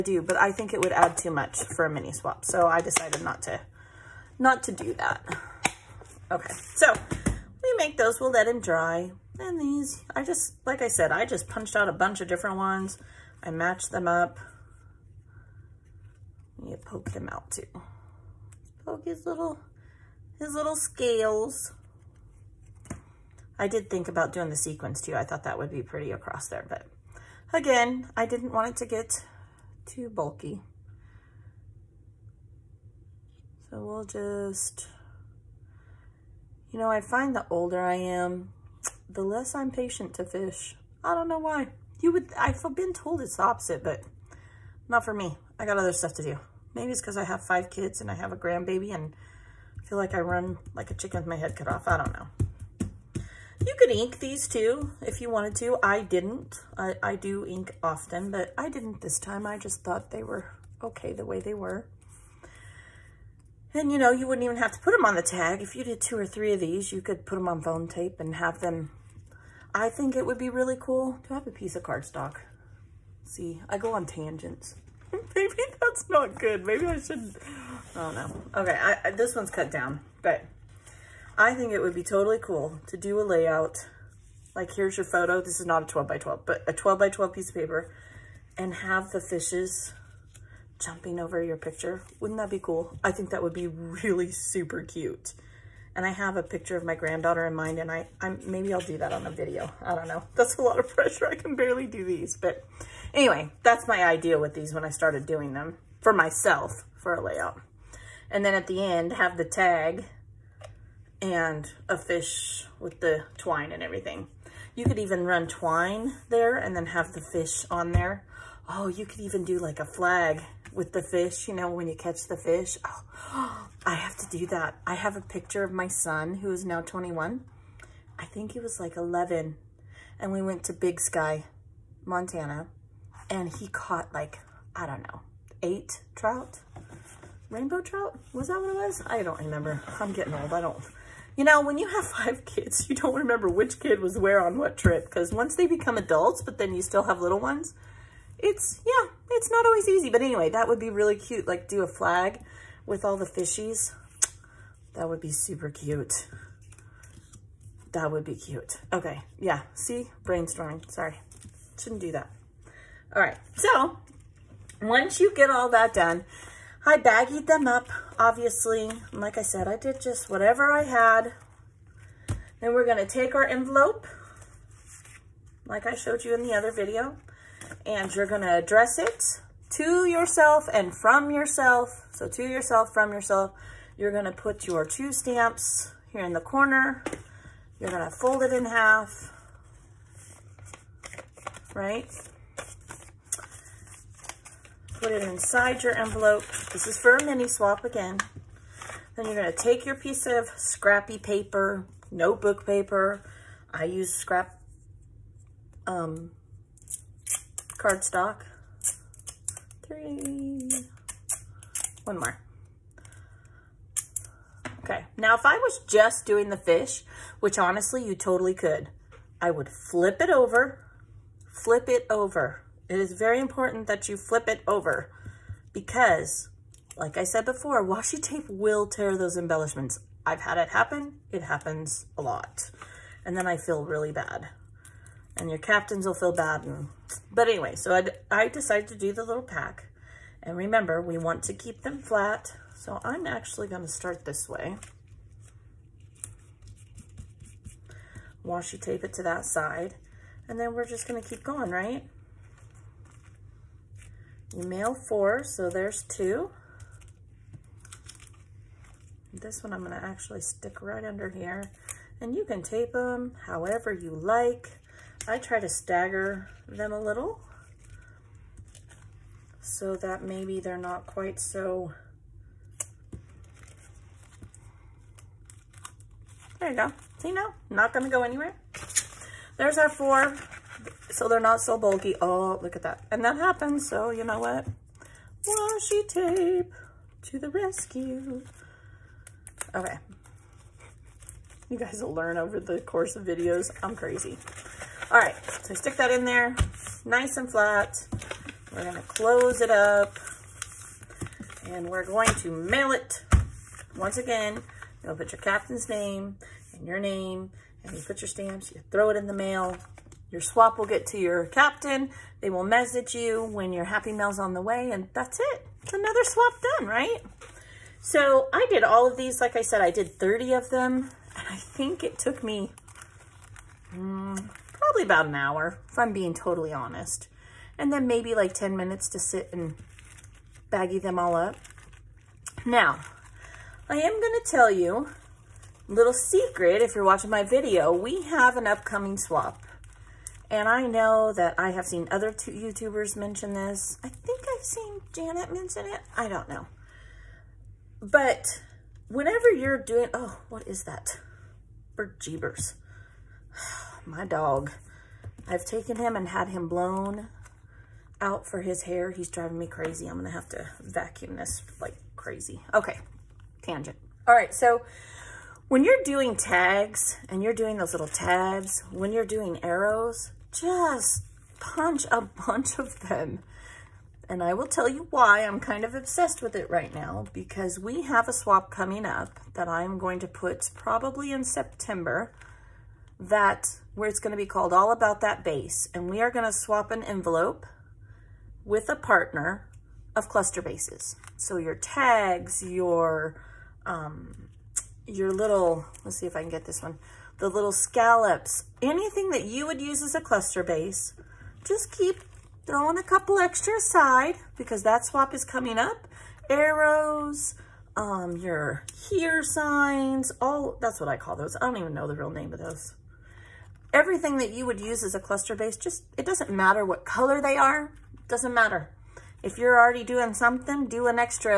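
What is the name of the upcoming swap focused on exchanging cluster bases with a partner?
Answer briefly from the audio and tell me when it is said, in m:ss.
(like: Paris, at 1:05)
All About That Base, at 6:24.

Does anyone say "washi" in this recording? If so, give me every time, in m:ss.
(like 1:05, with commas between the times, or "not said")
3:47, 4:08, 4:45.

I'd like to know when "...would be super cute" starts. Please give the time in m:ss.
2:35.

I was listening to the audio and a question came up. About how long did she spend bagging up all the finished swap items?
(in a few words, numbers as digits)
10 minutes.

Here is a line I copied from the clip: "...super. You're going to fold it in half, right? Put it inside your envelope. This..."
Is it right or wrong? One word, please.
wrong.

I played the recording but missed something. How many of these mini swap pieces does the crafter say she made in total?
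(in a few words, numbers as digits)
30.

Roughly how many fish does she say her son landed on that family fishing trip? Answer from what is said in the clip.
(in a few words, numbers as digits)
8.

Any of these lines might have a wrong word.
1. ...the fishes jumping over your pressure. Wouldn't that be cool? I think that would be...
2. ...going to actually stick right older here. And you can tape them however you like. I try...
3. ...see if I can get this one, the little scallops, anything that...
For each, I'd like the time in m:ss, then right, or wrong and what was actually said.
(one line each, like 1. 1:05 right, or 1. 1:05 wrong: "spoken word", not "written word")
1. 1:29 wrong: "picture", not "pressure"
2. 4:19 wrong: "under", not "older"
3. 6:36 right.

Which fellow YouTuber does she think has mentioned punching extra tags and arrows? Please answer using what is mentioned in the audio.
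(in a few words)
Janet.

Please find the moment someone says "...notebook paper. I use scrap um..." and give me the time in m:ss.
3:22.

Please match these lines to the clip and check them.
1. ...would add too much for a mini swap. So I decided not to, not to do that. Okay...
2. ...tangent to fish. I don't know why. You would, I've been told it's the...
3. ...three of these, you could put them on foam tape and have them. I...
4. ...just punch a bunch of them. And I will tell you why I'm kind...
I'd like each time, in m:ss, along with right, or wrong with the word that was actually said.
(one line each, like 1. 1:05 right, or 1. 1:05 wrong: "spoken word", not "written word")
1. 0:00 right
2. 0:39 wrong: "patient", not "tangent"
3. 1:06 right
4. 6:10 right.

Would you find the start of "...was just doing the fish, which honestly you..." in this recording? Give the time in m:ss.
3:35.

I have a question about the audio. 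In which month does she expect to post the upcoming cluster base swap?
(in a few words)
September.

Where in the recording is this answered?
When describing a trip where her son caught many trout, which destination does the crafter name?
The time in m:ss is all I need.
2:10.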